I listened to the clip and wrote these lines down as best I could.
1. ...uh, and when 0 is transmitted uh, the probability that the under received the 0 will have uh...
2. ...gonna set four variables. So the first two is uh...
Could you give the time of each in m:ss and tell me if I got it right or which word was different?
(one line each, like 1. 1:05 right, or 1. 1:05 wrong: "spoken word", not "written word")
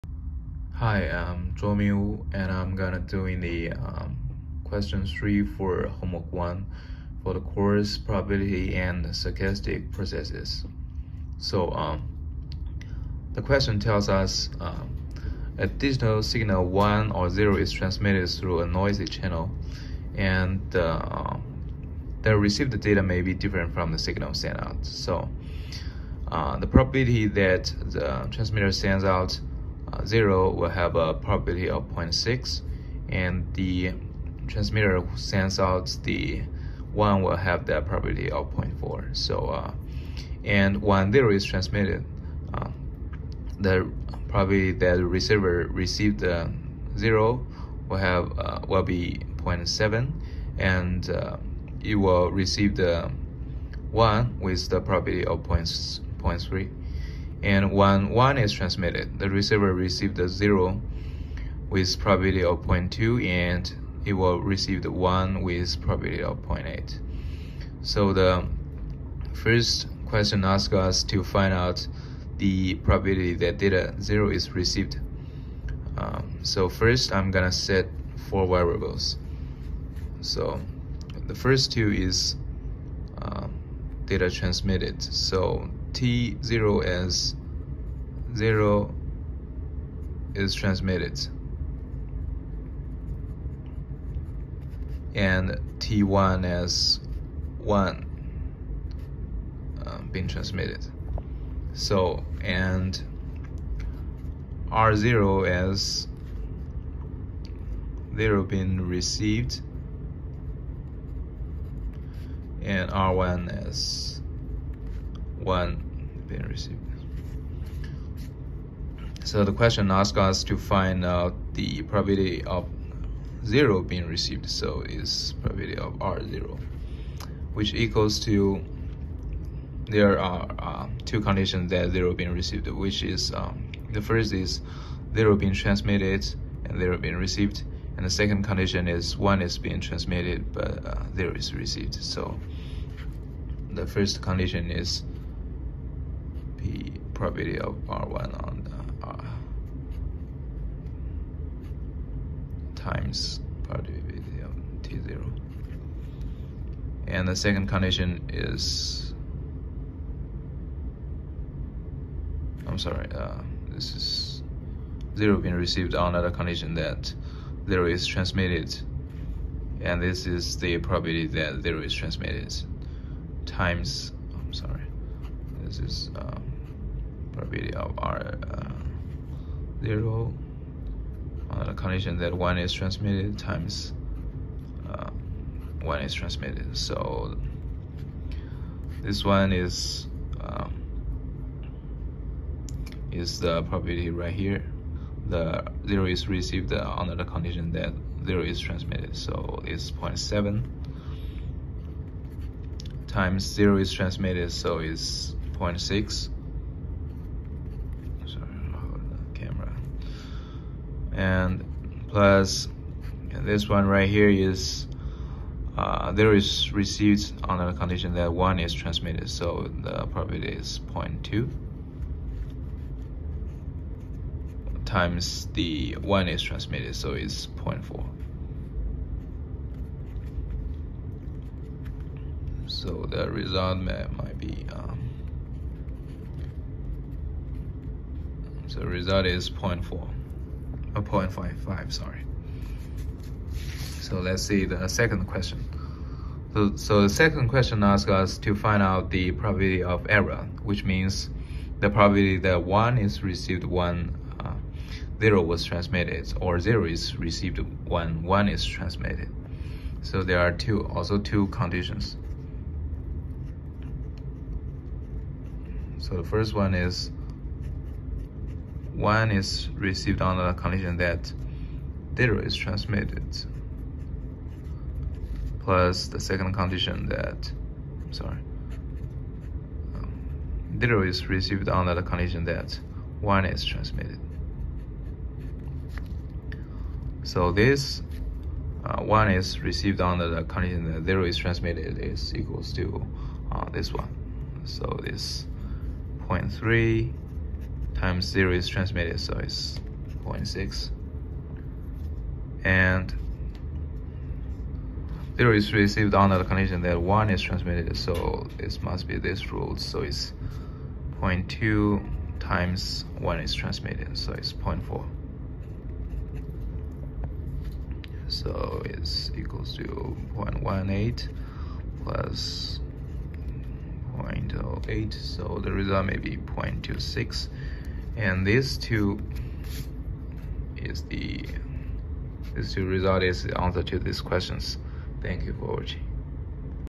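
1. 0:39 wrong: "receiver", not "under"
2. 1:17 right.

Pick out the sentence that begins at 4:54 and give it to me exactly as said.
So this 0.3 times zero is transmitted, so it's 0.6.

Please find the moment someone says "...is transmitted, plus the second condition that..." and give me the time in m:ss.
4:32.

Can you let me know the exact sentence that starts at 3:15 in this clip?
The zero is received uh, under the condition that zero is transmitted.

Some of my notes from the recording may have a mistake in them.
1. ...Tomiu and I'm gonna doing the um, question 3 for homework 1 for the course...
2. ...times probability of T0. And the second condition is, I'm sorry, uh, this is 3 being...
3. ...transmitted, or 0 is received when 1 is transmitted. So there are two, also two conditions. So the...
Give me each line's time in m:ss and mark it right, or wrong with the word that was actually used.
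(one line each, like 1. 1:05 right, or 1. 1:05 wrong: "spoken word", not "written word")
1. 0:01 right
2. 2:32 wrong: "0", not "3"
3. 4:15 right.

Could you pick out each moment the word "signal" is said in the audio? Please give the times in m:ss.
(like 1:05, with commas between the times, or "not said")
0:16, 0:23.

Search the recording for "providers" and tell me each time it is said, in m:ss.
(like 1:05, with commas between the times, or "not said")
not said.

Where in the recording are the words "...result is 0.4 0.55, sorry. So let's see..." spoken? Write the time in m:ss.
3:58.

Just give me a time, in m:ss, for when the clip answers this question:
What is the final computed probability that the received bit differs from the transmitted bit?
5:26.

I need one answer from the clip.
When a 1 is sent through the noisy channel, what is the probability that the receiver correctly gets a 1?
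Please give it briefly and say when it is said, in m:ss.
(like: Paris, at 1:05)
0.8, at 1:06.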